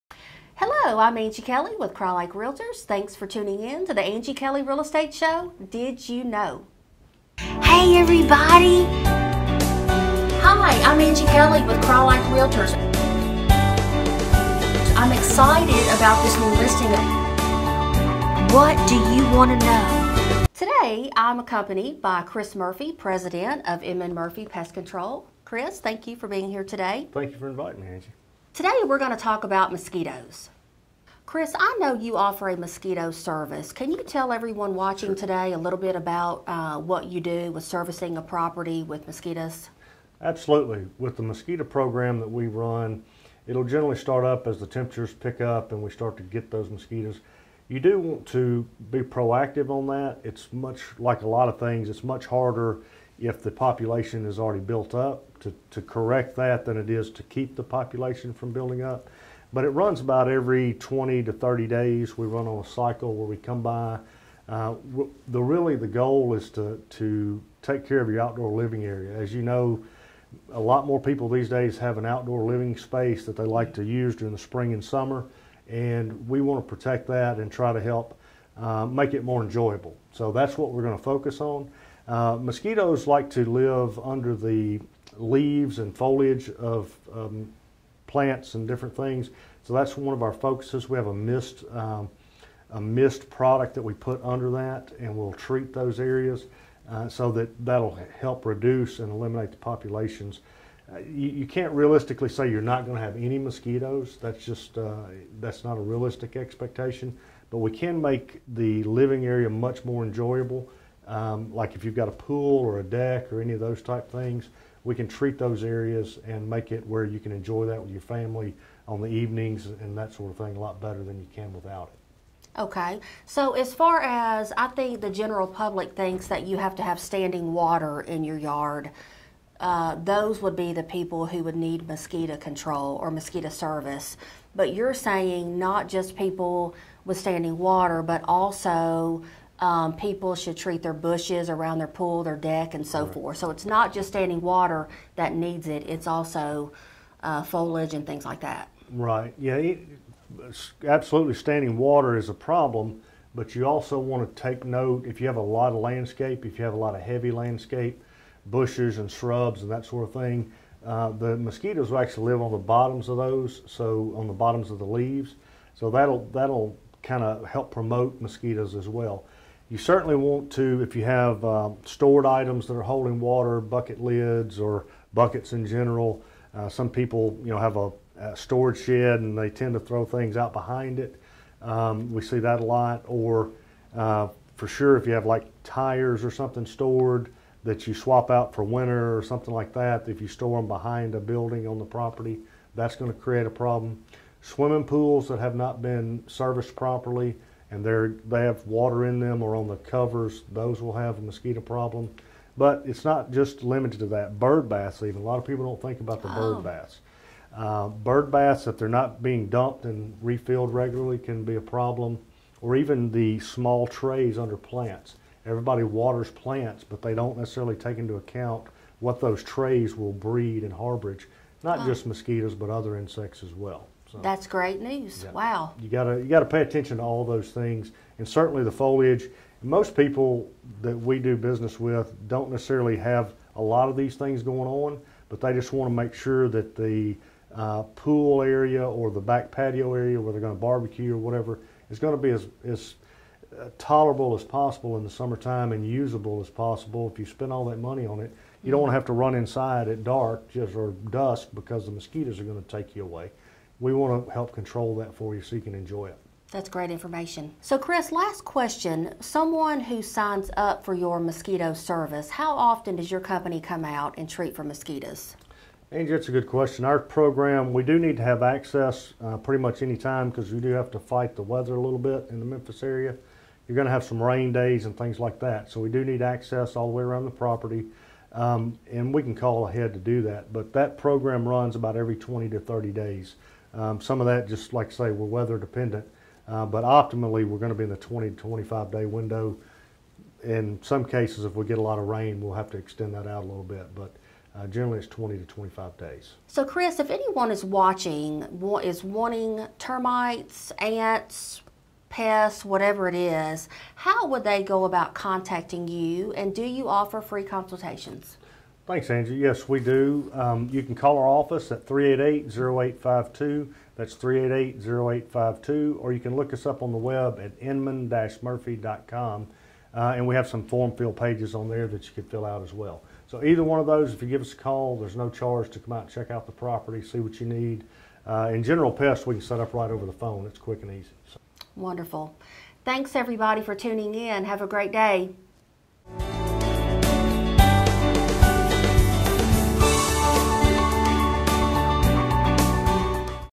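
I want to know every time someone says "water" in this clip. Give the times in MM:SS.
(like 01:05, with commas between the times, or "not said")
02:07, 02:17, 02:24, 02:31, 02:53, 03:18, 03:35.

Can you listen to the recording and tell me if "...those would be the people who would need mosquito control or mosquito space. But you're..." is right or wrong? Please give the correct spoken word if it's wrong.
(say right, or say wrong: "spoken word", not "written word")
wrong: "service", not "space".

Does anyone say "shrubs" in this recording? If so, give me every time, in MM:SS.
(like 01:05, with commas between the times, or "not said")
02:39.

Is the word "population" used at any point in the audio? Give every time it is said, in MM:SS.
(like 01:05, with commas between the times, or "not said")
00:53, 00:57, 01:39.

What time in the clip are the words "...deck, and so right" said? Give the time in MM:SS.
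02:22.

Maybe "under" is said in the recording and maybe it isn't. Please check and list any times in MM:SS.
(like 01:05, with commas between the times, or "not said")
01:23, 01:34, 03:34.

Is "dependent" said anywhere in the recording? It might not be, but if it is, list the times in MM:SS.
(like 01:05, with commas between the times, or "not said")
04:45.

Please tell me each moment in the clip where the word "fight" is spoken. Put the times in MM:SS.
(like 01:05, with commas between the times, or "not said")
04:30.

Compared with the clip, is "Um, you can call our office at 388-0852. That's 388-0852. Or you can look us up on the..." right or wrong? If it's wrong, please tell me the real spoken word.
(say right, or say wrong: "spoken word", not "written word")
right.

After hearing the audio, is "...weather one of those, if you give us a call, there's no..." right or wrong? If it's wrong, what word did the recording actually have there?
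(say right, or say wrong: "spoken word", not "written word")
wrong: "either", not "weather".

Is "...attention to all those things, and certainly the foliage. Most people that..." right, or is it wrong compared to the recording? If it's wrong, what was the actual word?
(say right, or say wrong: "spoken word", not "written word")
right.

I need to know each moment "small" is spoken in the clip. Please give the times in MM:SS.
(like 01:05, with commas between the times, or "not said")
03:33.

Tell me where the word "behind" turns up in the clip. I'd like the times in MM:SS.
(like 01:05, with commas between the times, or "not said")
03:00, 03:10.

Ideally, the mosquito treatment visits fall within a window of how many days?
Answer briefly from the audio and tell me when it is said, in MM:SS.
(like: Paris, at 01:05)
20 to 25 days, at 04:47.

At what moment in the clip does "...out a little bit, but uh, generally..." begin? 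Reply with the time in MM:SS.
04:53.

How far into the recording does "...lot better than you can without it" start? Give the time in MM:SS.
02:00.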